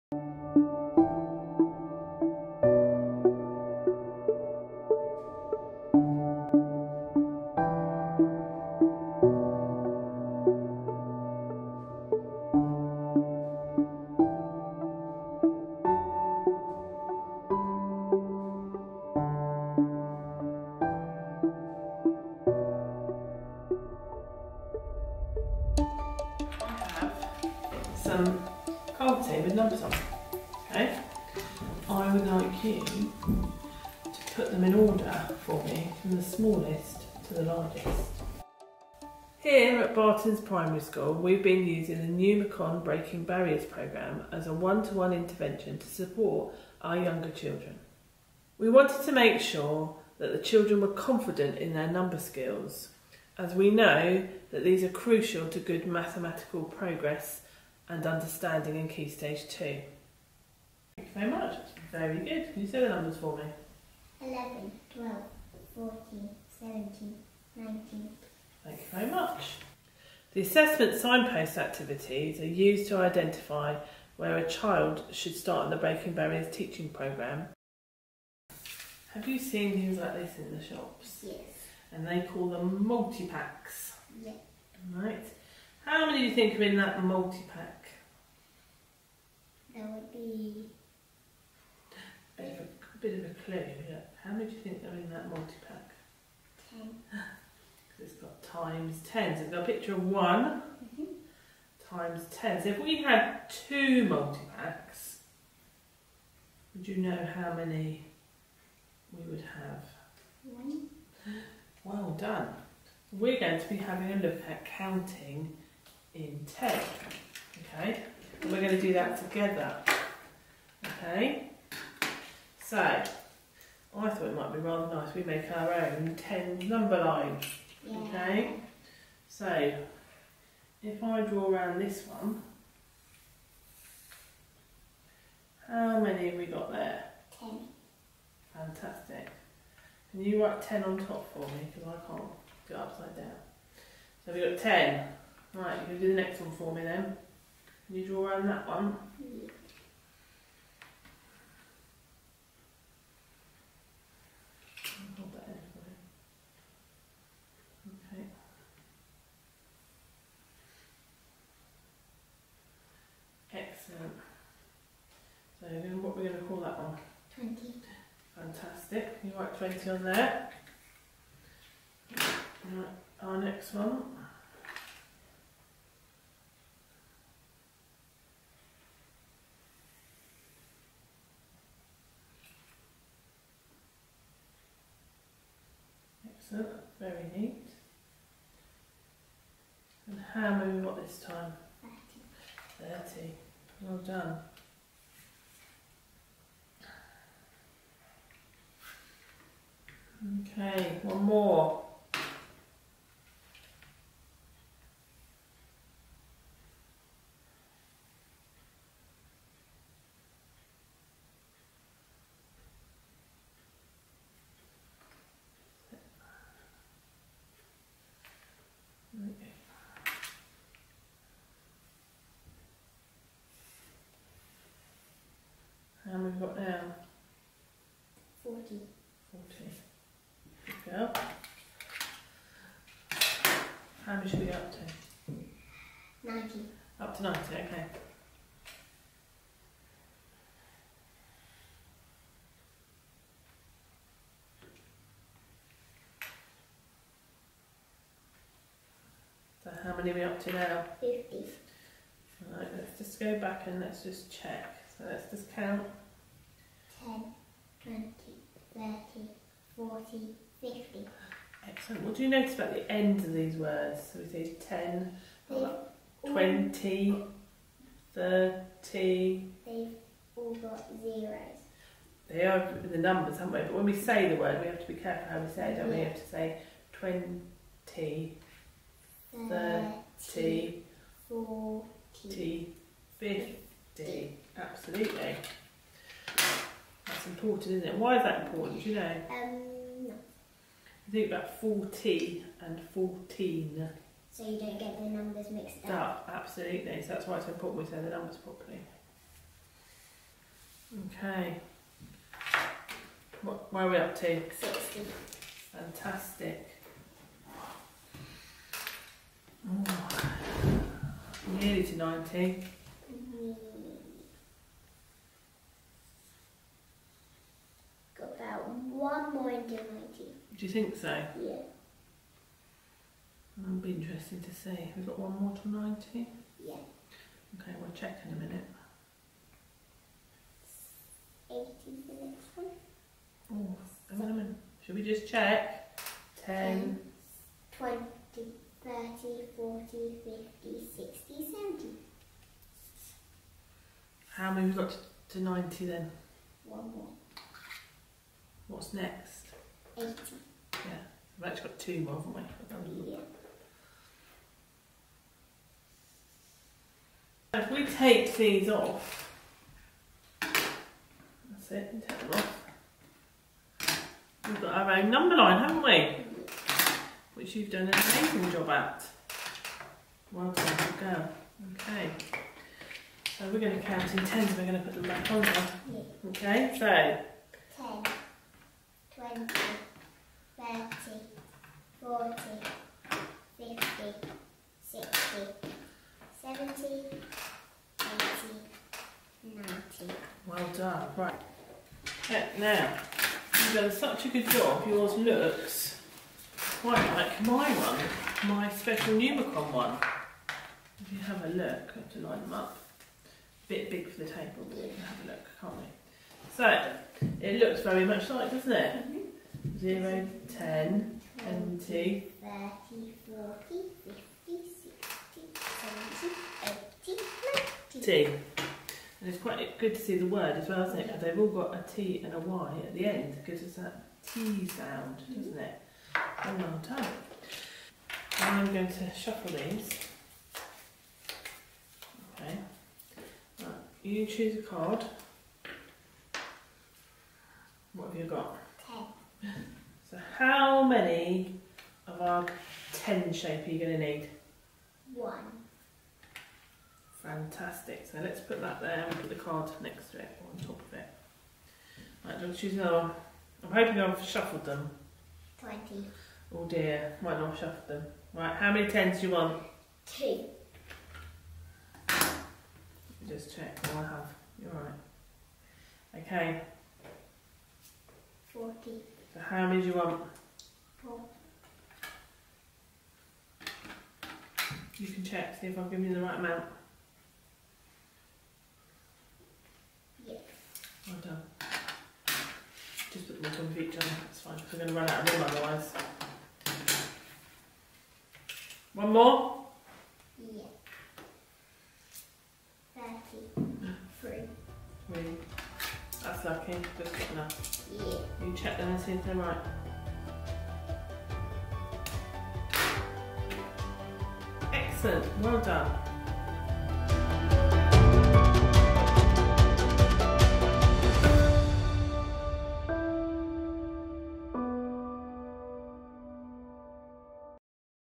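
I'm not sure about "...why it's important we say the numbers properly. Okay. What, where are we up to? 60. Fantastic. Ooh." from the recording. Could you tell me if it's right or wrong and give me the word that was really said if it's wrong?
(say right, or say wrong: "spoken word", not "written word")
right.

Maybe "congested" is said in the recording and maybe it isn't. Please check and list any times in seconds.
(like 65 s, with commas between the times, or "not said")
not said.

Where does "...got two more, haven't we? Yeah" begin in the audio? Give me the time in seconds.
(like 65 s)
351 s.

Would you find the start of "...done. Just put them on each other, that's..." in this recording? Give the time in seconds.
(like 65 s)
481 s.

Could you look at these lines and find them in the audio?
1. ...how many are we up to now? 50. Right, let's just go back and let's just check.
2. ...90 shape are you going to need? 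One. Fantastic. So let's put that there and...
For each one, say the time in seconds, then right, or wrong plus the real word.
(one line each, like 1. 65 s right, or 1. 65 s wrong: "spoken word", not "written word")
1. 249 s right
2. 442 s wrong: "10", not "90".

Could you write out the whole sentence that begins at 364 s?
We've got our own number line, haven't we?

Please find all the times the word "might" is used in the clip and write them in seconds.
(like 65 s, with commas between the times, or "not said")
124 s, 457 s.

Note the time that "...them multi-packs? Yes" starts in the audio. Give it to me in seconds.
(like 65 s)
82 s.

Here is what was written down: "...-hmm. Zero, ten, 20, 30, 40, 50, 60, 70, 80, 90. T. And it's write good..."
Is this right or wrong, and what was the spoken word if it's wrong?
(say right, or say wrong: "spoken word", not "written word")
wrong: "quite", not "write".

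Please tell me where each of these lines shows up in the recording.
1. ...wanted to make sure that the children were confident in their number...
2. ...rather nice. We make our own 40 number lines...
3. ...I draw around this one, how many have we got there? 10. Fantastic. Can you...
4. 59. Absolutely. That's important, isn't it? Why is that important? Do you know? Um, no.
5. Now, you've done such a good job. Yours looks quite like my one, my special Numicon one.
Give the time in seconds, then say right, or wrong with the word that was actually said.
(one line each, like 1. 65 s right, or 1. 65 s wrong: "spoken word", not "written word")
1. 48 s right
2. 124 s wrong: "10", not "40"
3. 131 s right
4. 283 s wrong: "50", not "59"
5. 392 s right.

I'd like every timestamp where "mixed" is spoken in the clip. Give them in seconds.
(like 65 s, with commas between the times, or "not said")
295 s.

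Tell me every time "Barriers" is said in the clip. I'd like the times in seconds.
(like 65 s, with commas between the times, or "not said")
43 s, 76 s.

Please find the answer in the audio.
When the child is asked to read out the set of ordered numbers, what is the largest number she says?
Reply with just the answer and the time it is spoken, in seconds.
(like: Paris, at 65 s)
19, at 67 s.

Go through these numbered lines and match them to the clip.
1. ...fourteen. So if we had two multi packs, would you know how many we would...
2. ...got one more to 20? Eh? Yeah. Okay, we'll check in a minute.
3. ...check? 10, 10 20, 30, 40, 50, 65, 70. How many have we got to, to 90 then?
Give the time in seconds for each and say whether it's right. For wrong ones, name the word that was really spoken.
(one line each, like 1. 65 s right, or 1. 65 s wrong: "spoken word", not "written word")
1. 102 s wrong: "ten", not "fourteen"
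2. 325 s wrong: "90", not "20"
3. 335 s wrong: "60", not "65".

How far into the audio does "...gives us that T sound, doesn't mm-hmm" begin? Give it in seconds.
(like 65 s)
423 s.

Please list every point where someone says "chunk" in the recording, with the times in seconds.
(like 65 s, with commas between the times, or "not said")
not said.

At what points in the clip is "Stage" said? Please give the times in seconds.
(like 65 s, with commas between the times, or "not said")
59 s.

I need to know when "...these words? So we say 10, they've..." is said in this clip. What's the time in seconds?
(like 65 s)
263 s.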